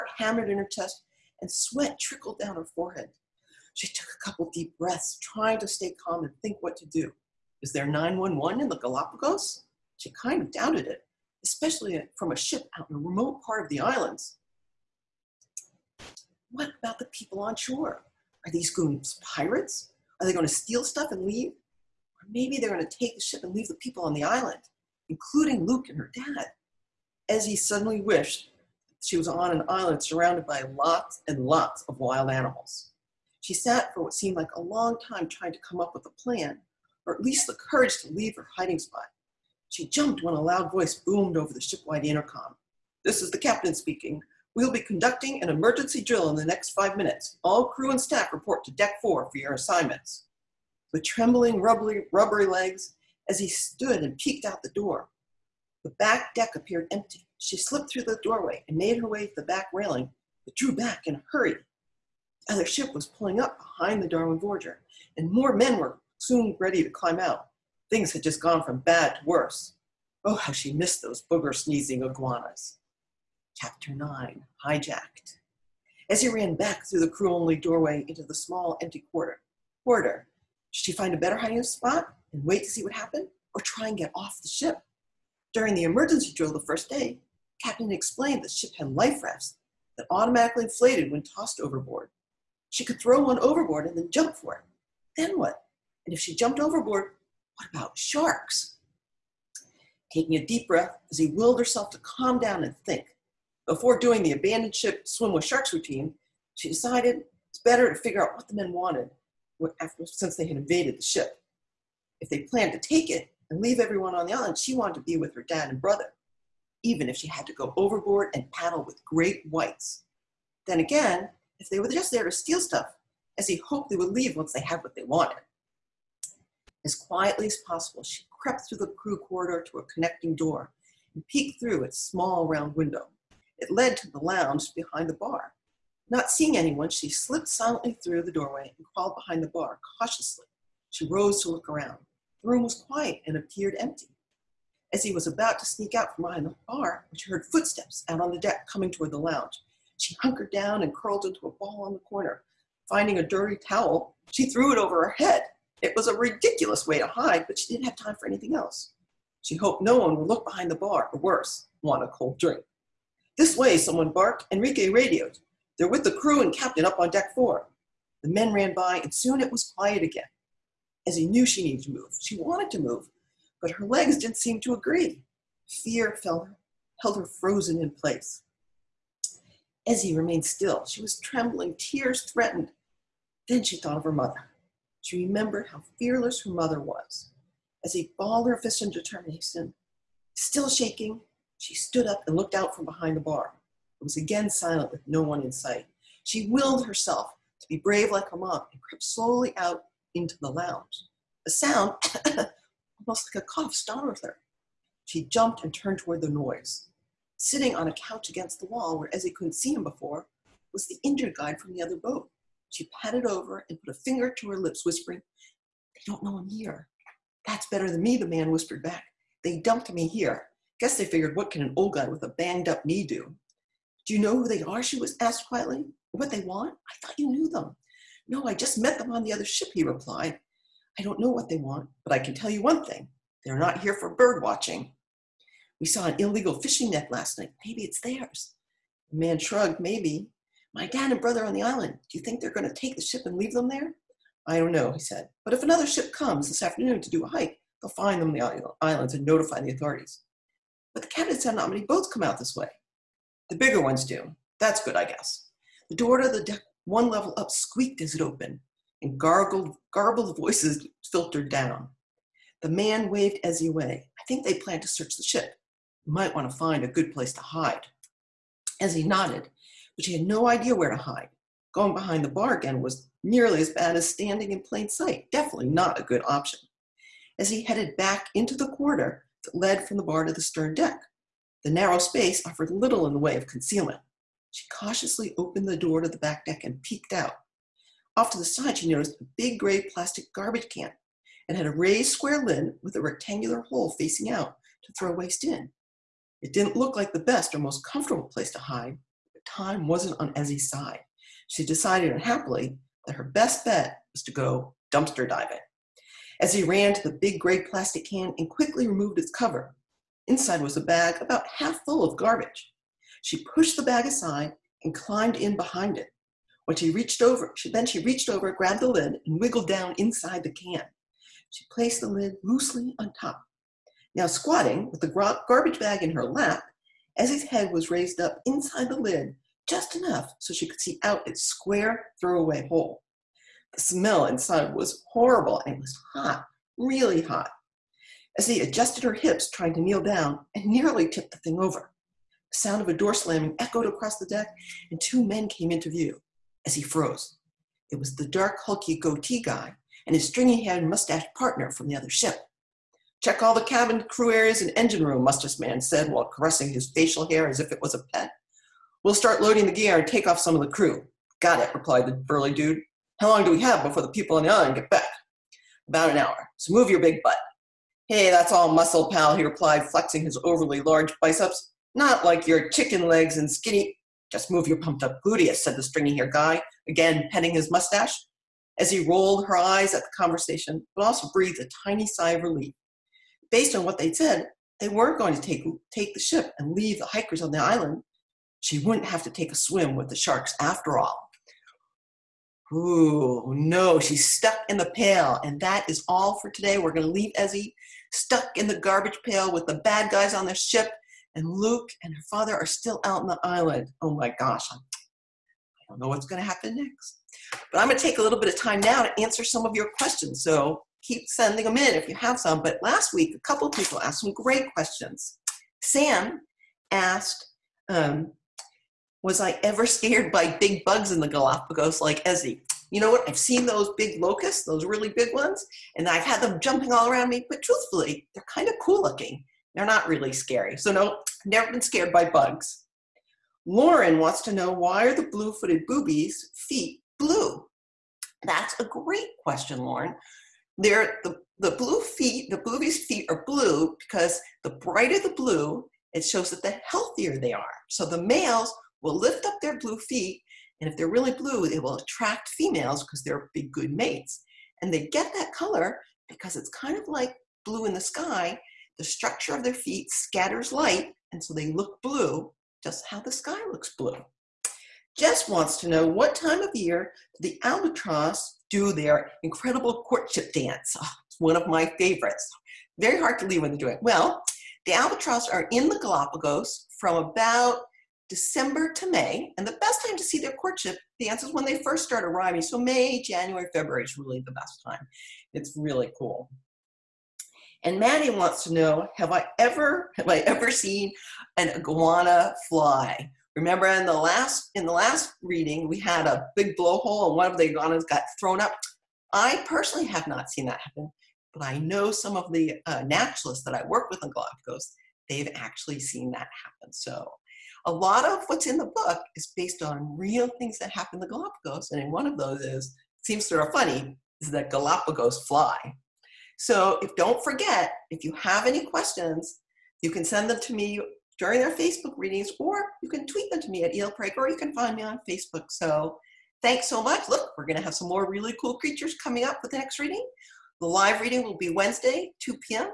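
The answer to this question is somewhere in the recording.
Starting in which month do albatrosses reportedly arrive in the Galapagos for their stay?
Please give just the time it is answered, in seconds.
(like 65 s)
478 s.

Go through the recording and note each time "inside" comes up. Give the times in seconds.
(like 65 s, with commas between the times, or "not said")
310 s, 319 s, 328 s, 334 s.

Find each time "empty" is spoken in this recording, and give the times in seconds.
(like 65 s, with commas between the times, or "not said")
56 s, 78 s, 143 s.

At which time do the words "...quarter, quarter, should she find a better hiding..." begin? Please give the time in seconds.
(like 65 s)
79 s.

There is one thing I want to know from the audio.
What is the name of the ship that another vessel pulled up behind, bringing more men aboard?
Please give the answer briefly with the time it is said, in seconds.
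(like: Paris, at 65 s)
Darwin Voyager, at 64 s.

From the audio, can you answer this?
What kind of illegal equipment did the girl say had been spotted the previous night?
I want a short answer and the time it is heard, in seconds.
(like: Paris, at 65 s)
fishing net, at 236 s.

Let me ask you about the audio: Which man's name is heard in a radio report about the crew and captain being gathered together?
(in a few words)
Enrique.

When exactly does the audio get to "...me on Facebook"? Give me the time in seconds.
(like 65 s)
524 s.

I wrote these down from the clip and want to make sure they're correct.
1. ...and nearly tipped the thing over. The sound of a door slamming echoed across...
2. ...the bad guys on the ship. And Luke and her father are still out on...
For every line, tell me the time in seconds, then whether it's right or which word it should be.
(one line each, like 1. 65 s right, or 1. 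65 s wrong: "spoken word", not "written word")
1. 340 s right
2. 399 s right.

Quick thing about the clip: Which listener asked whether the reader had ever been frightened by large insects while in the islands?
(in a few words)
Sam.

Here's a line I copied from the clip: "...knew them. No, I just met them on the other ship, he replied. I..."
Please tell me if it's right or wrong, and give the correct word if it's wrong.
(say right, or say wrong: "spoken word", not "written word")
right.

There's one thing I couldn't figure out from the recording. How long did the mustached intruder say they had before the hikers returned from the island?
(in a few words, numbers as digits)
about an hour.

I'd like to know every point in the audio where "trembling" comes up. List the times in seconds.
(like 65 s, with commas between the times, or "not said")
51 s, 181 s.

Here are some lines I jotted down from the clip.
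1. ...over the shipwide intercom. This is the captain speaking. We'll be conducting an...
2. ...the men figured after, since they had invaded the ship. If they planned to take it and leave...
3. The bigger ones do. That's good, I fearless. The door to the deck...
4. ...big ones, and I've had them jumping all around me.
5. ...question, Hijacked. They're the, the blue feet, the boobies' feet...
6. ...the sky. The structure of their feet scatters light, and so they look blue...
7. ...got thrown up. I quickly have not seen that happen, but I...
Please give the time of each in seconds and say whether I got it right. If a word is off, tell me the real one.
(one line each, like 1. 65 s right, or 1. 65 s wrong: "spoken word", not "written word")
1. 41 s right
2. 108 s wrong: "wanted", not "figured"
3. 253 s wrong: "guess", not "fearless"
4. 425 s right
5. 439 s wrong: "Lauren", not "Hijacked"
6. 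457 s right
7. 498 s wrong: "personally", not "quickly".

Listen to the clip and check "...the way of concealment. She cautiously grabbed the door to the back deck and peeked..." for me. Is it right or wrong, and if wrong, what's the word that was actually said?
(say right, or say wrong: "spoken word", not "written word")
wrong: "opened", not "grabbed".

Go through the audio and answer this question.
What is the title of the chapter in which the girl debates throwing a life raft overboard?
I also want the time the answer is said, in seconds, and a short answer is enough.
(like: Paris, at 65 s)
Hijacked, at 74 s.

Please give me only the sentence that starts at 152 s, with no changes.
Finding a dirty towel, she threw it over her head.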